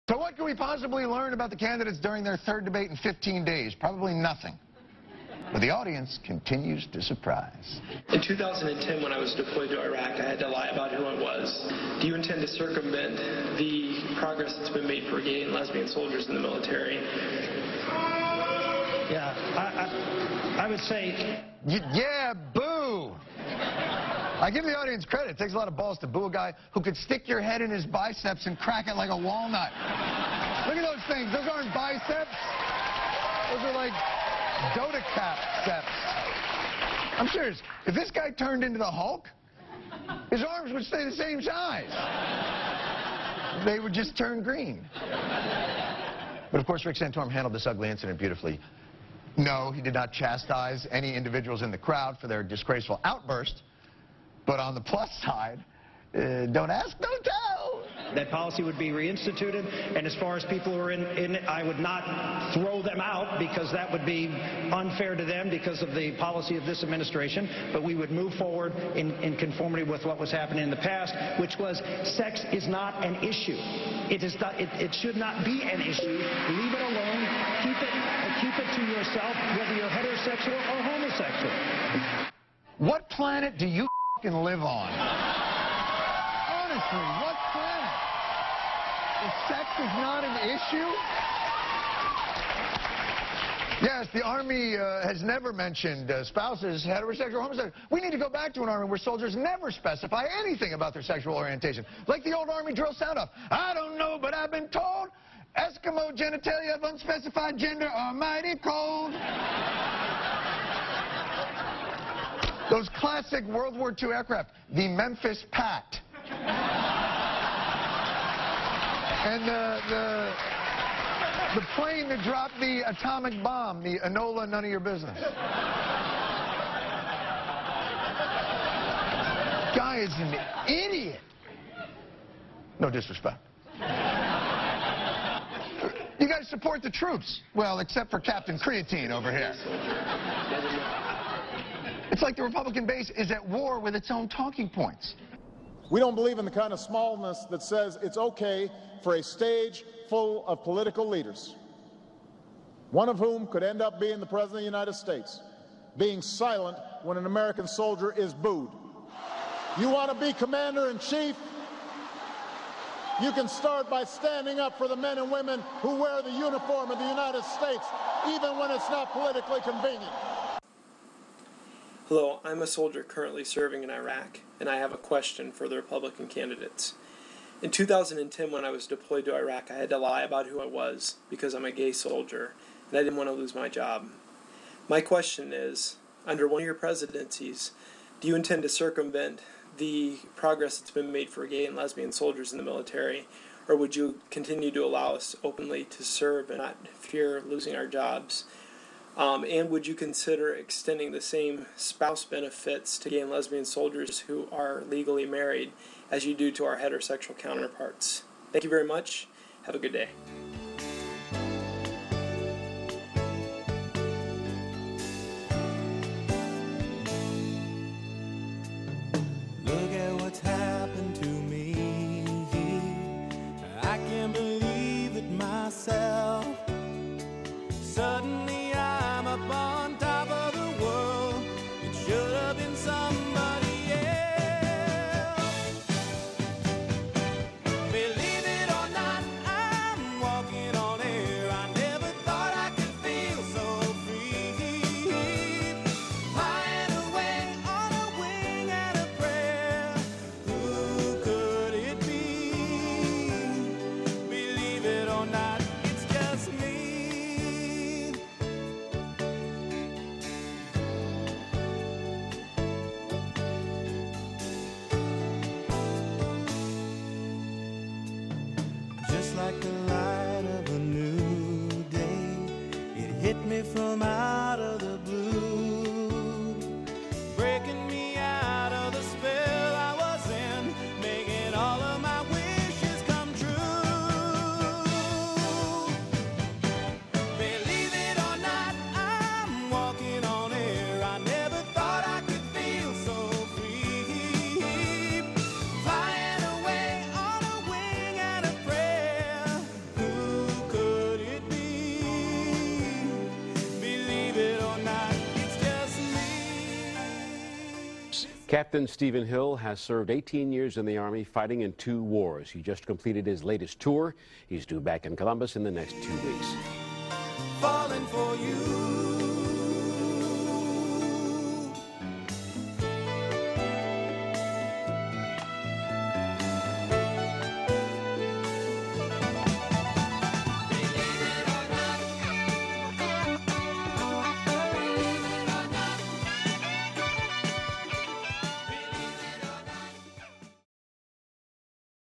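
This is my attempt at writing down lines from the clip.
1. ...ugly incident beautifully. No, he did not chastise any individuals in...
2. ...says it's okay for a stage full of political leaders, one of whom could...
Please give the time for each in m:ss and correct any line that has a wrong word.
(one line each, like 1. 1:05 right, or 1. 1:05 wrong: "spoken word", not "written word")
1. 0:47 right
2. 2:27 right.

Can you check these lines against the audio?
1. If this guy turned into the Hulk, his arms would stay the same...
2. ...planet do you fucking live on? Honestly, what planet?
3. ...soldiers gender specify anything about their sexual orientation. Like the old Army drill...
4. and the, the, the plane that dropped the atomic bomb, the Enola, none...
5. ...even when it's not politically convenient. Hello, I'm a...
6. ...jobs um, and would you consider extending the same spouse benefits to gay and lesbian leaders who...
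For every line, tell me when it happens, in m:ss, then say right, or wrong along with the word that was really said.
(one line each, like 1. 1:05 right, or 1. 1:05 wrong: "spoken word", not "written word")
1. 0:37 right
2. 1:23 right
3. 1:38 wrong: "never", not "gender"
4. 1:59 right
5. 2:48 right
6. 3:17 wrong: "soldiers", not "leaders".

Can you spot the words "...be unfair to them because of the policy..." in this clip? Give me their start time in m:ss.
1:04.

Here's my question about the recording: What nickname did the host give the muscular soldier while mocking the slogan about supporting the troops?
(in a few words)
Captain Creatine.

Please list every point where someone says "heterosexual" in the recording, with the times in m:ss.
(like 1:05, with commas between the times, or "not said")
1:19, 1:36, 3:26.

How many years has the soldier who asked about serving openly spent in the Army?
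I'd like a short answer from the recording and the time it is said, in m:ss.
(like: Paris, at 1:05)
18, at 5:10.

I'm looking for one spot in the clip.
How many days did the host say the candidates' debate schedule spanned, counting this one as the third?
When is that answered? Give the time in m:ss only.
0:02.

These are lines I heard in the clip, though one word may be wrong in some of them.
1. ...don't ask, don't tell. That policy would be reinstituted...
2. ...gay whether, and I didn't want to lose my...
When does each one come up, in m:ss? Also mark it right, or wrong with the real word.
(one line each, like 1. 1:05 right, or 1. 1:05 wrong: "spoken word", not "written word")
1. 0:56 right
2. 3:01 wrong: "soldier", not "whether".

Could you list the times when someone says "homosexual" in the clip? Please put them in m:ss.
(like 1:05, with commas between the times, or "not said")
1:20, 1:37.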